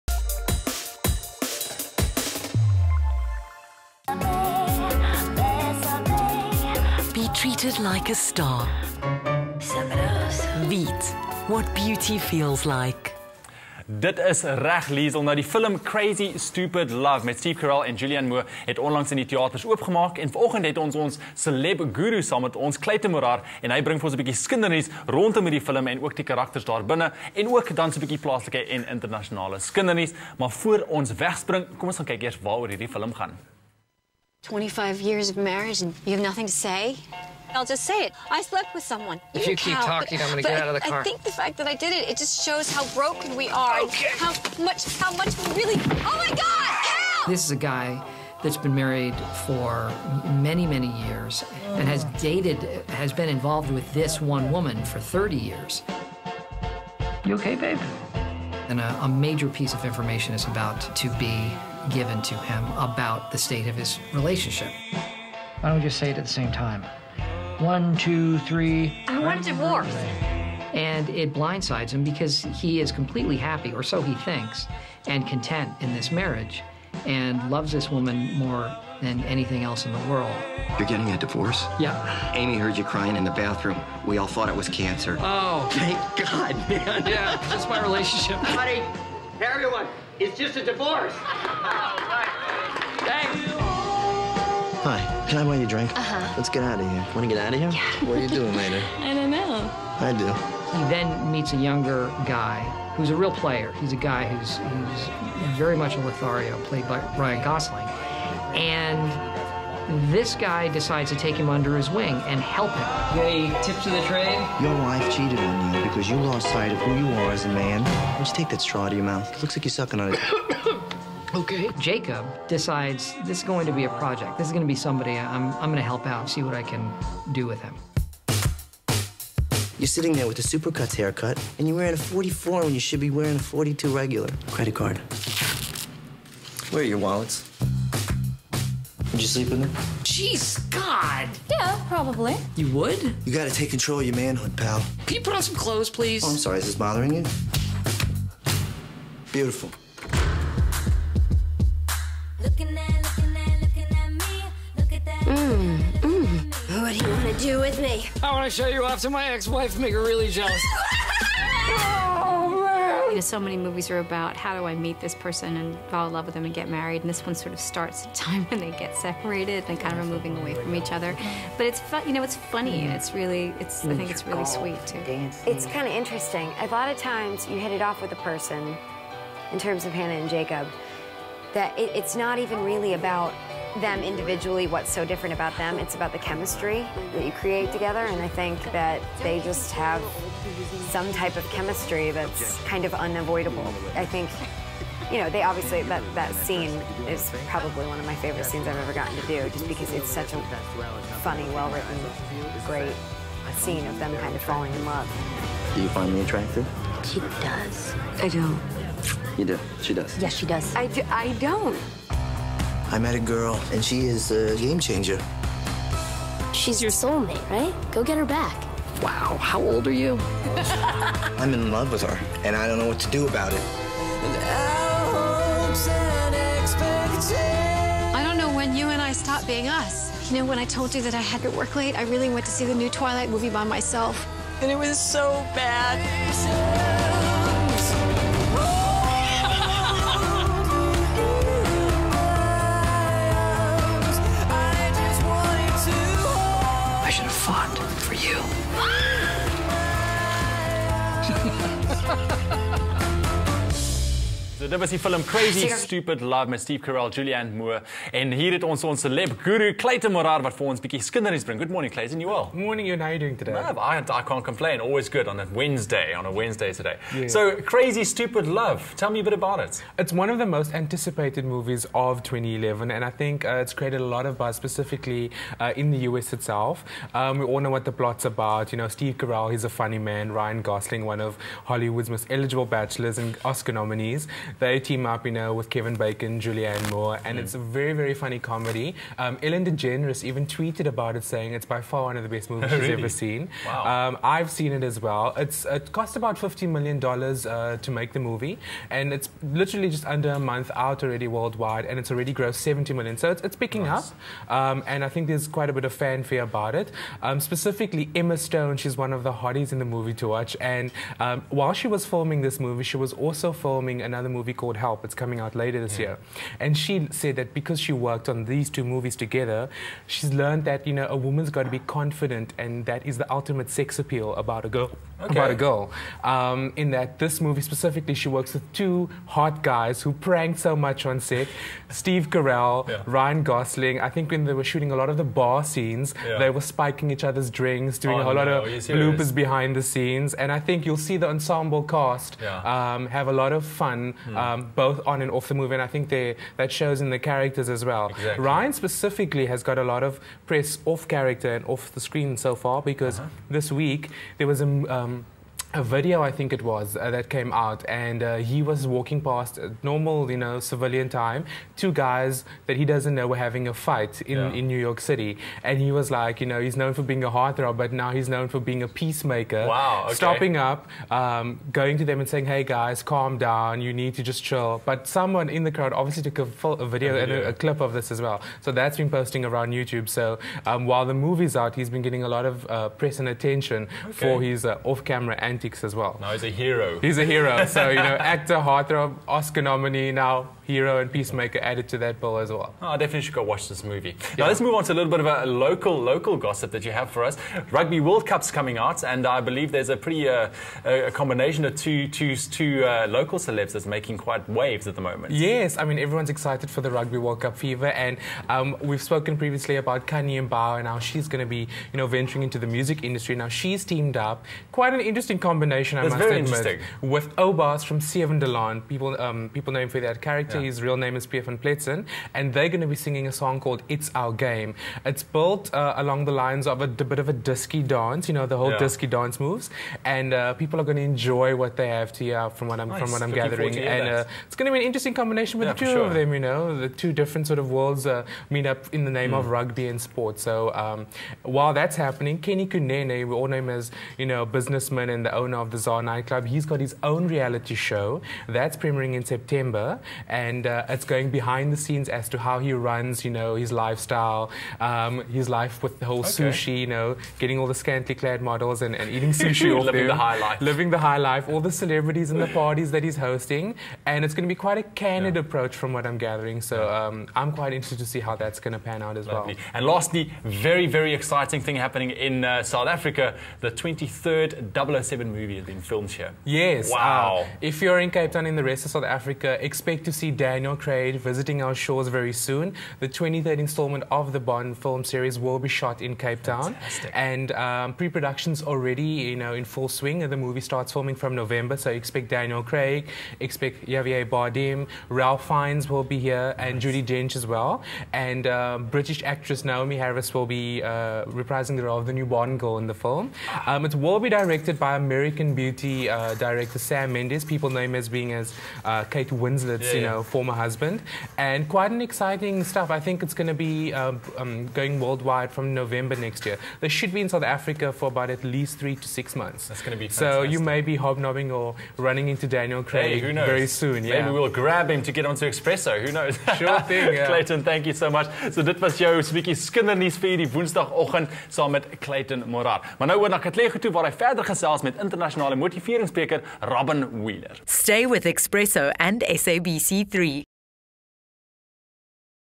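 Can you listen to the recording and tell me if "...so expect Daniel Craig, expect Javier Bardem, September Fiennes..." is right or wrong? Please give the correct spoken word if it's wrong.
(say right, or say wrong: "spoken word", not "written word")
wrong: "Ralph", not "September".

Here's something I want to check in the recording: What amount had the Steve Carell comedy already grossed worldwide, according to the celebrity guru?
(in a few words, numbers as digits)
70 million.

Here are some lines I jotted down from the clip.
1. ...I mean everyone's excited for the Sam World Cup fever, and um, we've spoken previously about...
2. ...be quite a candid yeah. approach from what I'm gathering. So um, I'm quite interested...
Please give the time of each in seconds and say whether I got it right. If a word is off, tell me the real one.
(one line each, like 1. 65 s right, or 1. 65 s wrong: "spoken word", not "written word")
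1. 405 s wrong: "Rugby", not "Sam"
2. 464 s right.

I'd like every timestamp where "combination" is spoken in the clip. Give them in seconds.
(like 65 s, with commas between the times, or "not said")
401 s, 415 s, 435 s.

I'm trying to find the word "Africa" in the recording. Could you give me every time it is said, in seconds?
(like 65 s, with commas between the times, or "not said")
472 s, 479 s, 517 s.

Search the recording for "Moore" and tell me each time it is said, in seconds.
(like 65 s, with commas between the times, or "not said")
18 s, 257 s, 286 s.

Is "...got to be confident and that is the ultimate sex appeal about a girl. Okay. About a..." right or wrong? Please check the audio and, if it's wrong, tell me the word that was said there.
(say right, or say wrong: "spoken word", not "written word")
right.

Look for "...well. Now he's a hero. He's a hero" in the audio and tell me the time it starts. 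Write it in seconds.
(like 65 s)
385 s.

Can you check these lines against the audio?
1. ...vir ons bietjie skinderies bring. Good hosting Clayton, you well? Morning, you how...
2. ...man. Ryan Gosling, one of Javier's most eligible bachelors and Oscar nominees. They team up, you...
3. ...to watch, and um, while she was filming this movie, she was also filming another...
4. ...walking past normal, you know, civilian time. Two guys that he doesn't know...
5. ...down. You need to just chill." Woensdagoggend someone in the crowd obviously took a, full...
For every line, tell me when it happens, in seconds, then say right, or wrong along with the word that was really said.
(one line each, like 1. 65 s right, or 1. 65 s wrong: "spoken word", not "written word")
1. 260 s wrong: "morning", not "hosting"
2. 279 s wrong: "Hollywood", not "Javier"
3. 310 s right
4. 358 s right
5. 373 s wrong: "But", not "Woensdagoggend".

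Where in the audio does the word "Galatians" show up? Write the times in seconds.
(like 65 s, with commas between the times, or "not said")
not said.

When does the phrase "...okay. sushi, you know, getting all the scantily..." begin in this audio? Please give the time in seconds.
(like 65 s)
456 s.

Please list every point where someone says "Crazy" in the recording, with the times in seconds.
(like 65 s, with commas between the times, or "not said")
15 s, 255 s, 267 s.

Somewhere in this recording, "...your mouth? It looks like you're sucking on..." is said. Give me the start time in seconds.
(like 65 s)
118 s.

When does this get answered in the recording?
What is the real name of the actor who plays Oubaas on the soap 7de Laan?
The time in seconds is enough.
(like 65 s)
421 s.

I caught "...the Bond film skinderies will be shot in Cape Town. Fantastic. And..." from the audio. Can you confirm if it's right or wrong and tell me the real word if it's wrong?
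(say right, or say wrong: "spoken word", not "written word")
wrong: "series", not "skinderies".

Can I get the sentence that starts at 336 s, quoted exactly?
they were spiking each other's drinks, doing oh, a whole no, lot of bloopers behind the scenes.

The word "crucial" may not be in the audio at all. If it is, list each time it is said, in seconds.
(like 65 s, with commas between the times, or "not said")
not said.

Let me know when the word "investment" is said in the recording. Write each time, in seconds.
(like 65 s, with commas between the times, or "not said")
not said.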